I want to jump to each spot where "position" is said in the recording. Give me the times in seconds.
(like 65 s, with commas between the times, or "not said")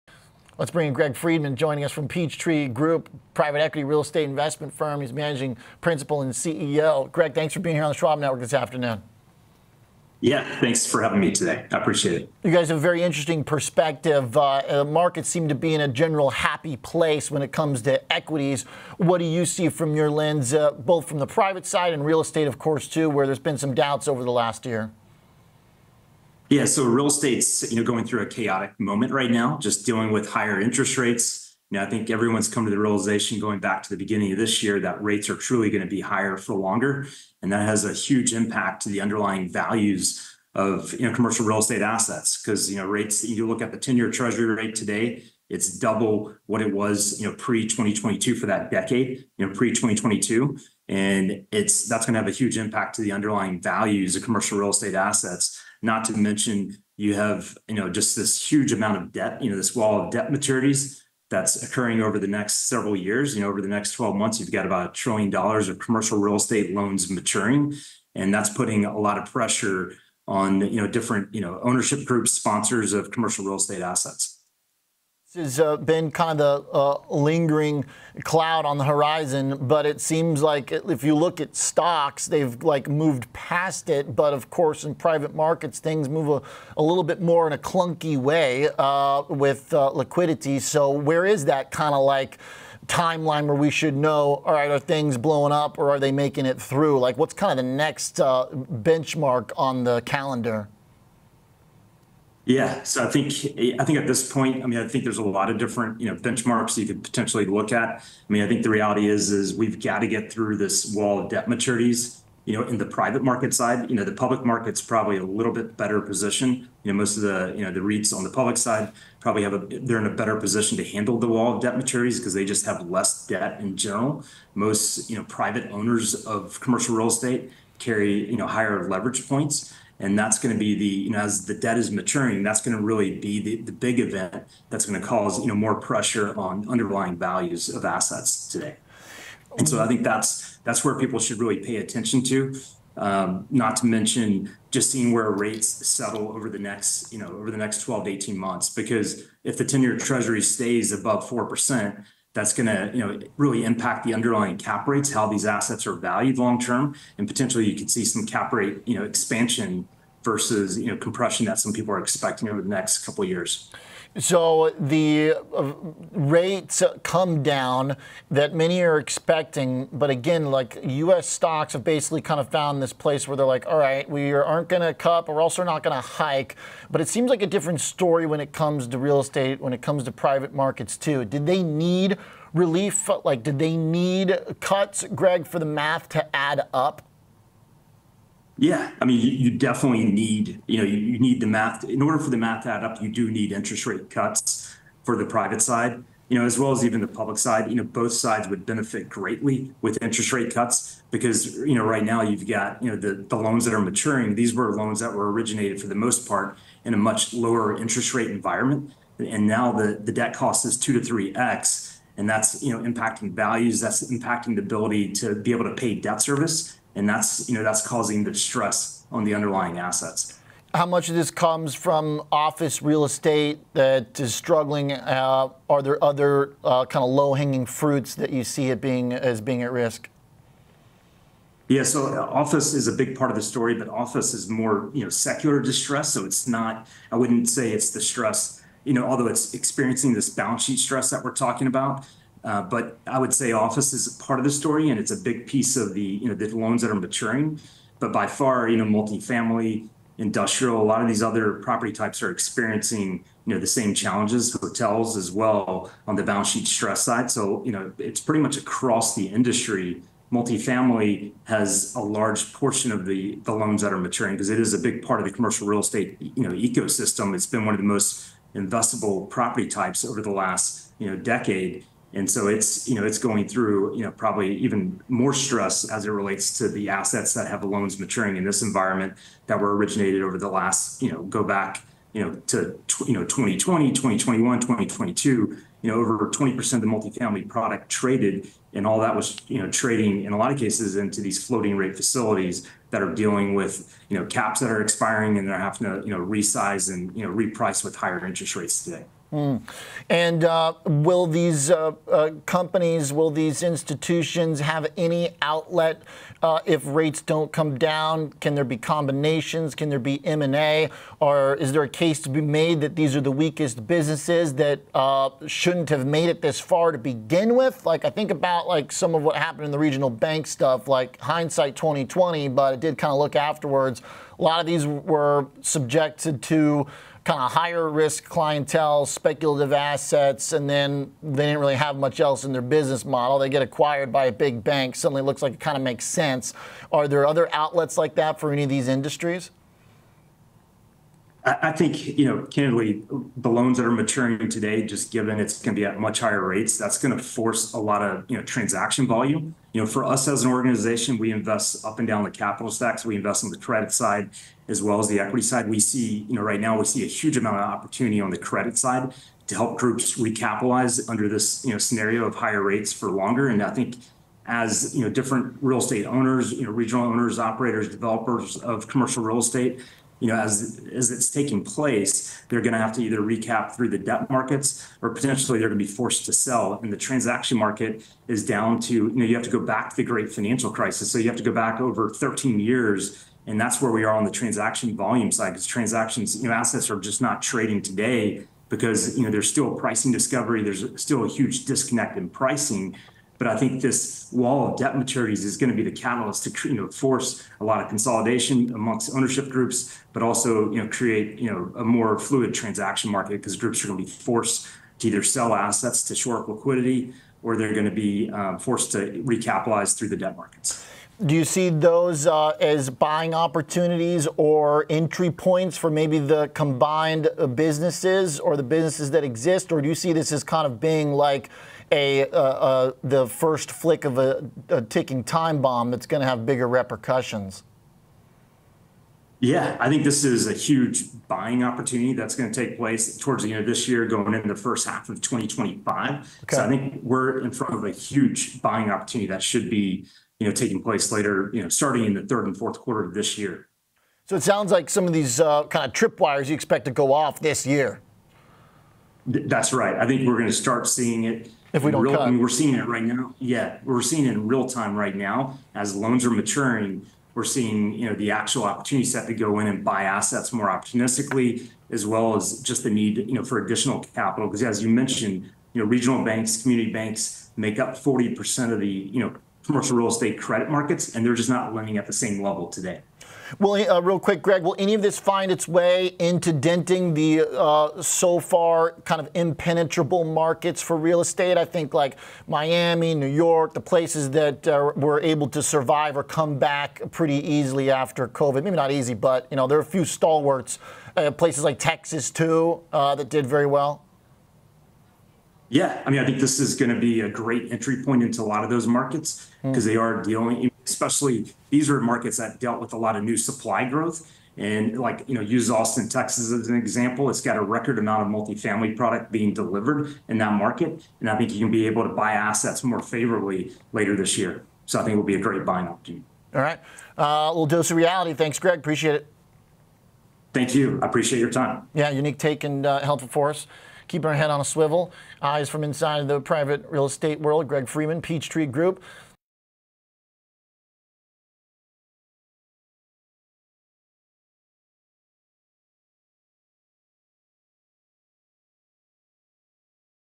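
116 s, 120 s.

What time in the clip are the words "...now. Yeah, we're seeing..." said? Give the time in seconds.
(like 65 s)
453 s.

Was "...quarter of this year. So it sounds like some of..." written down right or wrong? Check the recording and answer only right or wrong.
right.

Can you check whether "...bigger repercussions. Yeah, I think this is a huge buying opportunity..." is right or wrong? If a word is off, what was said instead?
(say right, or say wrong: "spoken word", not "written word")
right.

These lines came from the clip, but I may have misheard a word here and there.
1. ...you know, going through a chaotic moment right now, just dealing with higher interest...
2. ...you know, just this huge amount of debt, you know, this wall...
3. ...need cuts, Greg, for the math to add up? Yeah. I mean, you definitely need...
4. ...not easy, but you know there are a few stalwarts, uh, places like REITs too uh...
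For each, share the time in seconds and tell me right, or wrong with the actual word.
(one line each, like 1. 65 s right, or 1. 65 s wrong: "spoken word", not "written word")
1. 27 s right
2. 57 s right
3. 183 s right
4. 488 s wrong: "Texas", not "REITs".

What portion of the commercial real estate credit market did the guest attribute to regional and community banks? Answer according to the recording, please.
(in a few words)
40%.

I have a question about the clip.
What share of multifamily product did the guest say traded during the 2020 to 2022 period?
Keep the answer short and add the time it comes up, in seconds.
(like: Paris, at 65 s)
over 20%, at 285 s.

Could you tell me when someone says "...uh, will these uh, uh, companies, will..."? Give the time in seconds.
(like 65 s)
300 s.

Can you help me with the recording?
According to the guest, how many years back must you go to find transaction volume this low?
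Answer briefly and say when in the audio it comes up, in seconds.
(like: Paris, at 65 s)
over 13 years, at 381 s.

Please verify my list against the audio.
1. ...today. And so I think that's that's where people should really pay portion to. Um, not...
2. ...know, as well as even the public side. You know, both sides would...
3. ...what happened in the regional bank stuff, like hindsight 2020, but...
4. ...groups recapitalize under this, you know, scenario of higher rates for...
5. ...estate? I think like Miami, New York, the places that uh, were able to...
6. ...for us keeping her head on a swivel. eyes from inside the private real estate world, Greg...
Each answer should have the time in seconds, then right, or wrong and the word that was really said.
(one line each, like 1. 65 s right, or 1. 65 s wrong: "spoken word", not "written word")
1. 138 s wrong: "attention", not "portion"
2. 196 s right
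3. 319 s right
4. 359 s right
5. 481 s right
6. 523 s right.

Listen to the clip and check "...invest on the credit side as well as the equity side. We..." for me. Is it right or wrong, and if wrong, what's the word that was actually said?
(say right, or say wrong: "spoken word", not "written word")
right.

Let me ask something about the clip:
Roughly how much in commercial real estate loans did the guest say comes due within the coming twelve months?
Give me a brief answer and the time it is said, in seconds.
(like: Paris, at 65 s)
$1 trillion, at 64 s.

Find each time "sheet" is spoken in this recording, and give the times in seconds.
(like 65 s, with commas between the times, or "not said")
240 s, 256 s.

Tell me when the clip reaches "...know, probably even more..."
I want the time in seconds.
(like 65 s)
274 s.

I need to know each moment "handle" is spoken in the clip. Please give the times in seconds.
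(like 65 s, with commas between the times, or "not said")
120 s.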